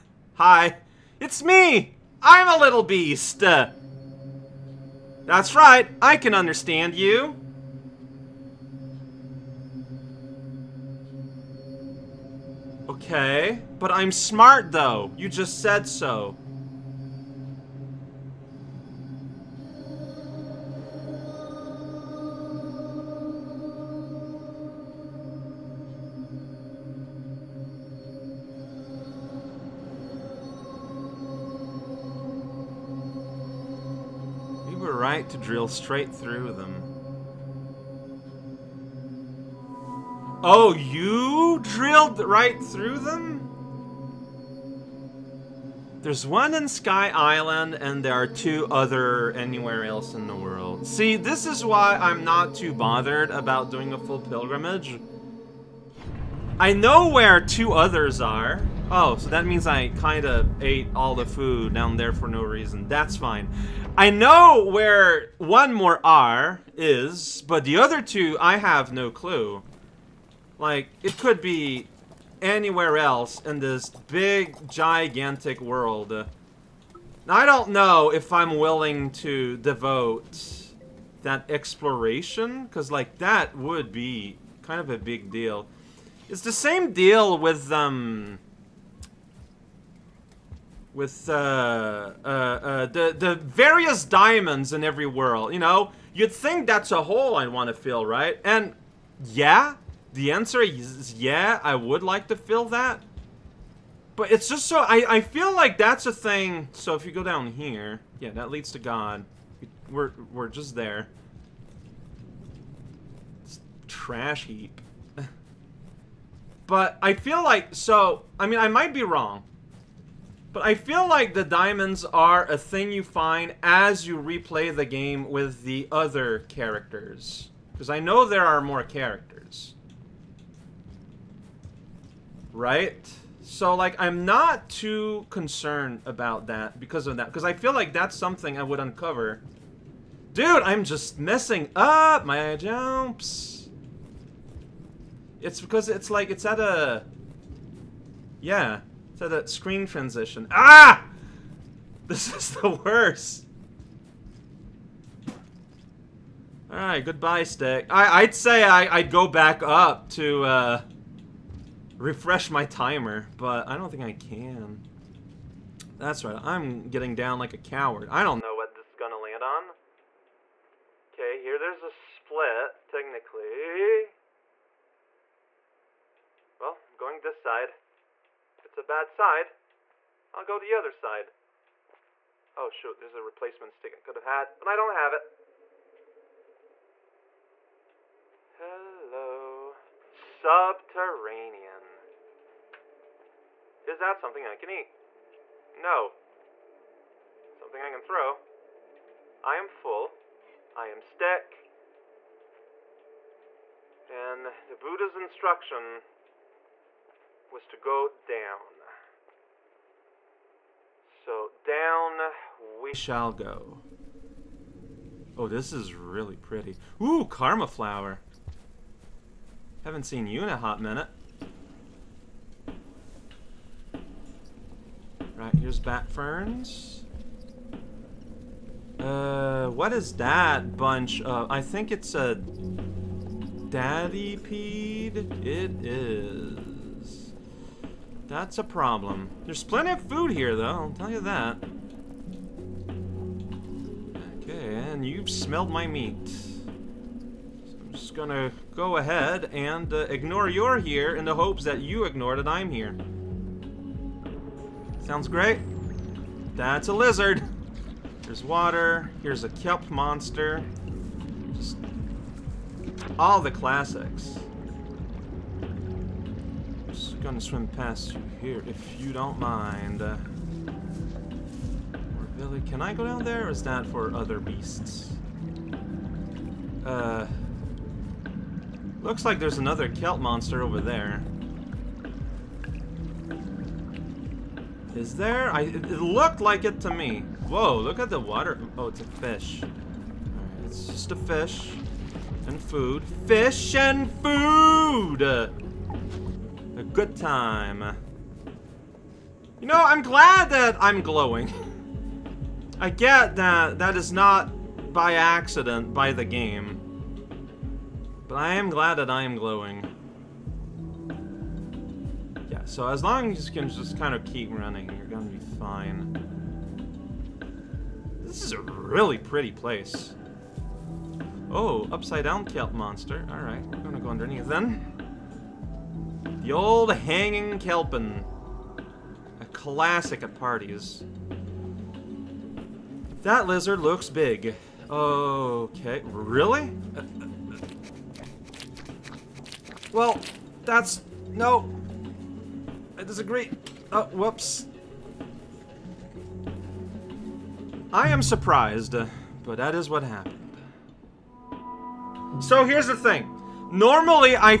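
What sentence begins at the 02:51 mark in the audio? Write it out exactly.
Okay, here there's a split, technically.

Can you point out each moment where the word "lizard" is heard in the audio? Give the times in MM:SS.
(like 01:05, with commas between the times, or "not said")
04:16, 05:33.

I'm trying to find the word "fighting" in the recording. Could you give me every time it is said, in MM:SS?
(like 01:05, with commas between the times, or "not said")
not said.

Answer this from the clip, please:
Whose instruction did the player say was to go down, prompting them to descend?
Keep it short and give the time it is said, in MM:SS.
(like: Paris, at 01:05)
the Buddha, at 03:24.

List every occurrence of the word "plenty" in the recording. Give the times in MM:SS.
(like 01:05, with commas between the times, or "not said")
03:59.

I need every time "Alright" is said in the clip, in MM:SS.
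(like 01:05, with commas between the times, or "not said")
02:36, 05:23.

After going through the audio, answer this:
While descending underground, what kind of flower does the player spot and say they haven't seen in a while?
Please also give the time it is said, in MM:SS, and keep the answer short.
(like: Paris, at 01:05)
Karma Flower, at 03:37.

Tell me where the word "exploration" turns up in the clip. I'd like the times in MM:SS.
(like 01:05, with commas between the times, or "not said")
01:21.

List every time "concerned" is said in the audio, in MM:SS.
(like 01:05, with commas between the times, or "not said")
02:15.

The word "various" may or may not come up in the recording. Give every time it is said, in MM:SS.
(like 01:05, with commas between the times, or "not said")
01:33.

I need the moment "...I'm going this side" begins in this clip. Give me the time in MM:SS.
02:56.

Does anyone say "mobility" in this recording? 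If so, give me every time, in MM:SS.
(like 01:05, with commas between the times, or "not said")
not said.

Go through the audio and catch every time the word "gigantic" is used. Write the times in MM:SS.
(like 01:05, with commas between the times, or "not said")
01:14.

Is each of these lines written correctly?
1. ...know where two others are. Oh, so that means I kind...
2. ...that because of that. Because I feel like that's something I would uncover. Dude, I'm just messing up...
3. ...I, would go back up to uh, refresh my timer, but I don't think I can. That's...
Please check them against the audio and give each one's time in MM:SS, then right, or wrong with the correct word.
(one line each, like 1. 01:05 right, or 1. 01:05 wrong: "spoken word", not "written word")
1. 00:56 right
2. 02:16 right
3. 02:38 right.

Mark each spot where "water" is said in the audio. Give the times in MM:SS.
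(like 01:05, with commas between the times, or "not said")
04:18, 04:48.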